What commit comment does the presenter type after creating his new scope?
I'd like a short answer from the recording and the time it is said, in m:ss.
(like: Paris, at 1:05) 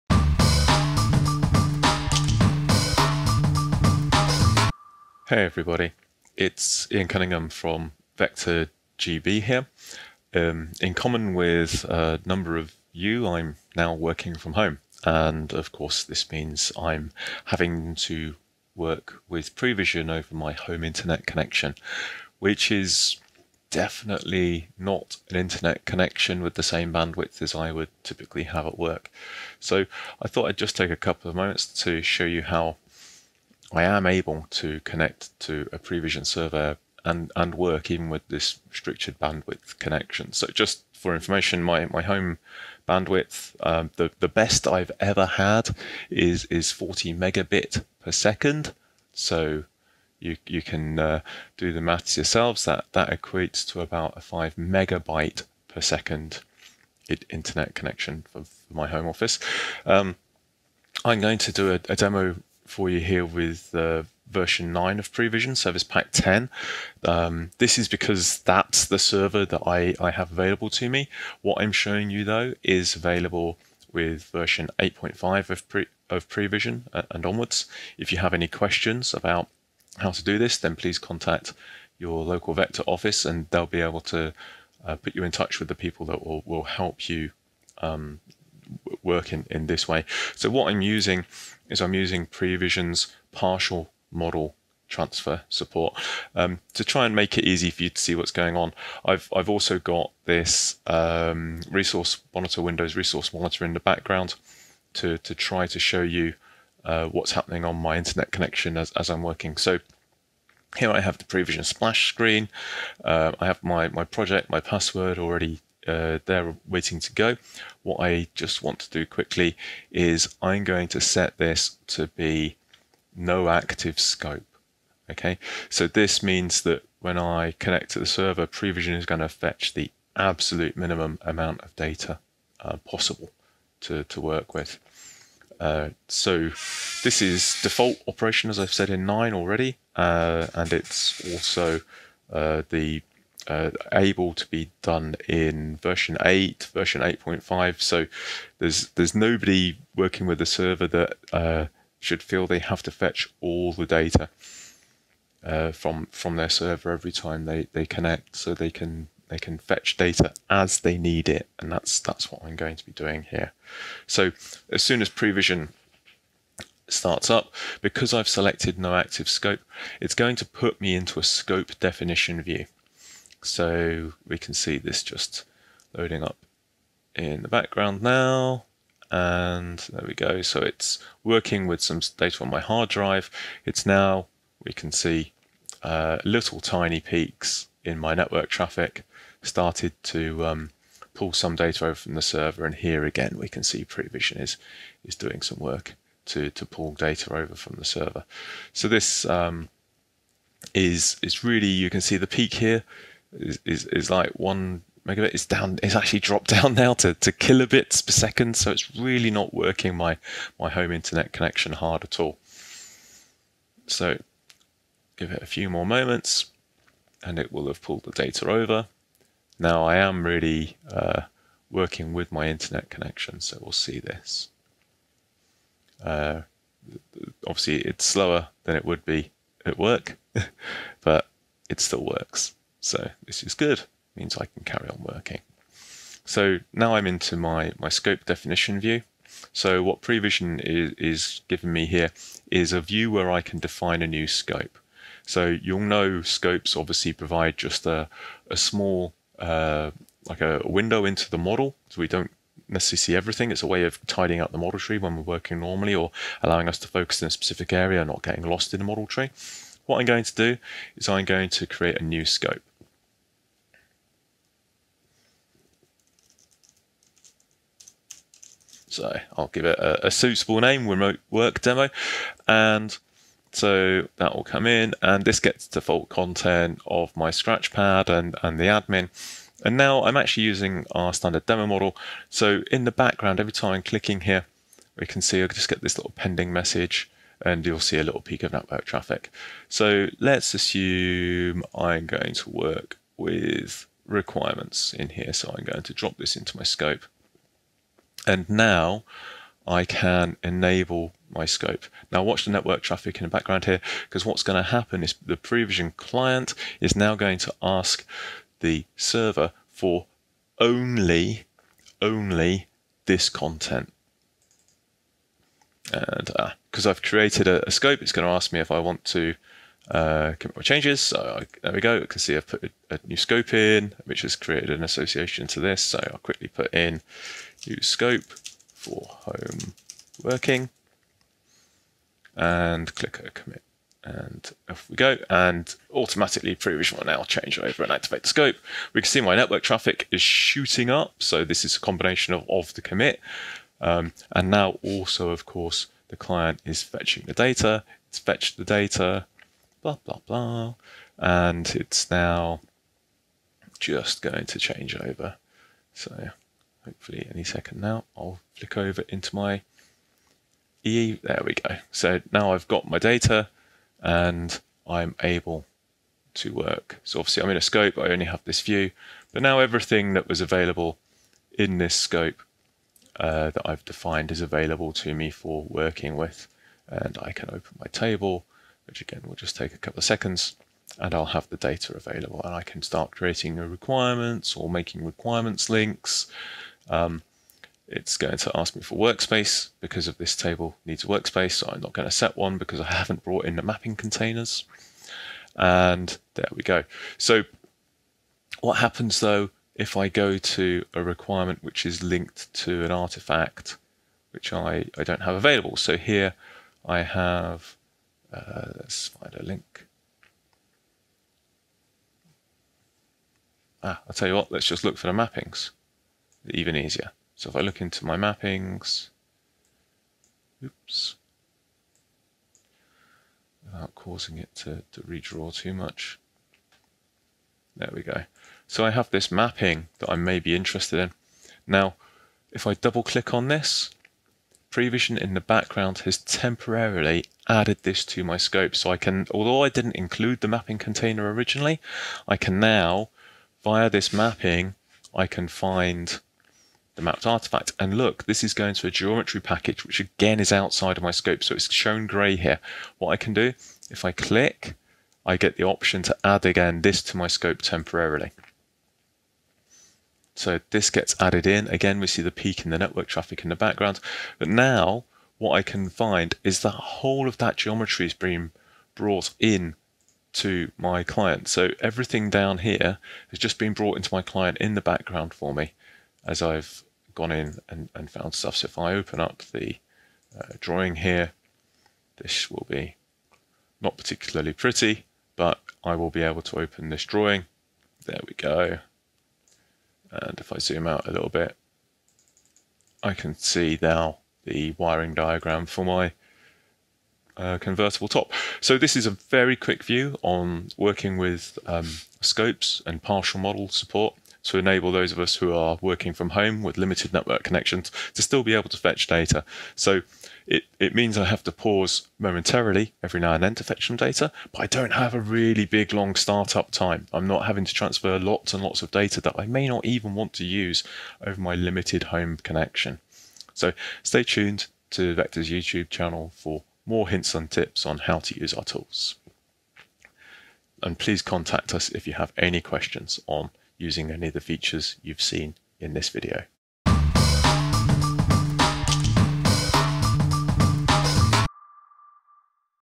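use scope for home working, at 5:27.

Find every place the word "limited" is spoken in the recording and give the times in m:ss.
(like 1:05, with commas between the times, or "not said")
8:26, 8:41.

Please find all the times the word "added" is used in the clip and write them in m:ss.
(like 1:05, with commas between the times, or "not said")
7:17, 7:41.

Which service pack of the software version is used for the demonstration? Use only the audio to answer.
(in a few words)
Service pack 10.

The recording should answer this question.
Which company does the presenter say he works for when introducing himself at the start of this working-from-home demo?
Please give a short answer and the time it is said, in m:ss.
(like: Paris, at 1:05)
Vector GB, at 0:08.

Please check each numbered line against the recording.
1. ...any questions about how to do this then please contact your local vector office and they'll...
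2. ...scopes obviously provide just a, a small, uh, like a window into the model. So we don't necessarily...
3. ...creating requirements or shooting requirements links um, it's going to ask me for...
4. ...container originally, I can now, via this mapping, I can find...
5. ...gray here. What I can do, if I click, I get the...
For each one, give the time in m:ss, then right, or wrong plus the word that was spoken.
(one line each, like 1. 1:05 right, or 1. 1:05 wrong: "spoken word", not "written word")
1. 1:18 right
2. 4:06 right
3. 6:23 wrong: "making", not "shooting"
4. 7:20 right
5. 7:32 right.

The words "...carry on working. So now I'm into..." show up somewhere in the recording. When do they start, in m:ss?
3:54.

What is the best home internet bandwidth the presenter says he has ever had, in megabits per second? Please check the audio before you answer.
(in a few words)
40.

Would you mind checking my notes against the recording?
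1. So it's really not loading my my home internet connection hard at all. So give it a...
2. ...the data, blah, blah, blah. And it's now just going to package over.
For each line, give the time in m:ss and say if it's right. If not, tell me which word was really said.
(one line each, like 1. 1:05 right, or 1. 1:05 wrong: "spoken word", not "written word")
1. 3:28 wrong: "working", not "loading"
2. 5:48 wrong: "change", not "package".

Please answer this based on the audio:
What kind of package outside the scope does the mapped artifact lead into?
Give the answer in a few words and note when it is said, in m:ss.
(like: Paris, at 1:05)
Geometry package, at 7:28.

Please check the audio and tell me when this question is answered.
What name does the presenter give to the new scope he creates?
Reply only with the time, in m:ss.
4:30.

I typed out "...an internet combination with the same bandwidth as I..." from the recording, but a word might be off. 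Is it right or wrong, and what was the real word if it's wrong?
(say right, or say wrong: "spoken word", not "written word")
wrong: "connection", not "combination".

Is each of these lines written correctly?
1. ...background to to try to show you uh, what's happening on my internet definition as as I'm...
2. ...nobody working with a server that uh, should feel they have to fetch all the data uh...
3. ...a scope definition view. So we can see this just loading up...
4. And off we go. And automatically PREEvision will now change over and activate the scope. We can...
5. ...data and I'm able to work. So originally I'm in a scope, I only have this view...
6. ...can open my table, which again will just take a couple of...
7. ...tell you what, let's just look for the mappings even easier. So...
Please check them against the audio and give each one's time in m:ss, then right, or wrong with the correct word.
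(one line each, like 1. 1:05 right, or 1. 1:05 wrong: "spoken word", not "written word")
1. 1:43 wrong: "connection", not "definition"
2. 2:29 right
3. 2:51 right
4. 5:34 right
5. 6:02 wrong: "obviously", not "originally"
6. 6:17 right
7. 6:54 right.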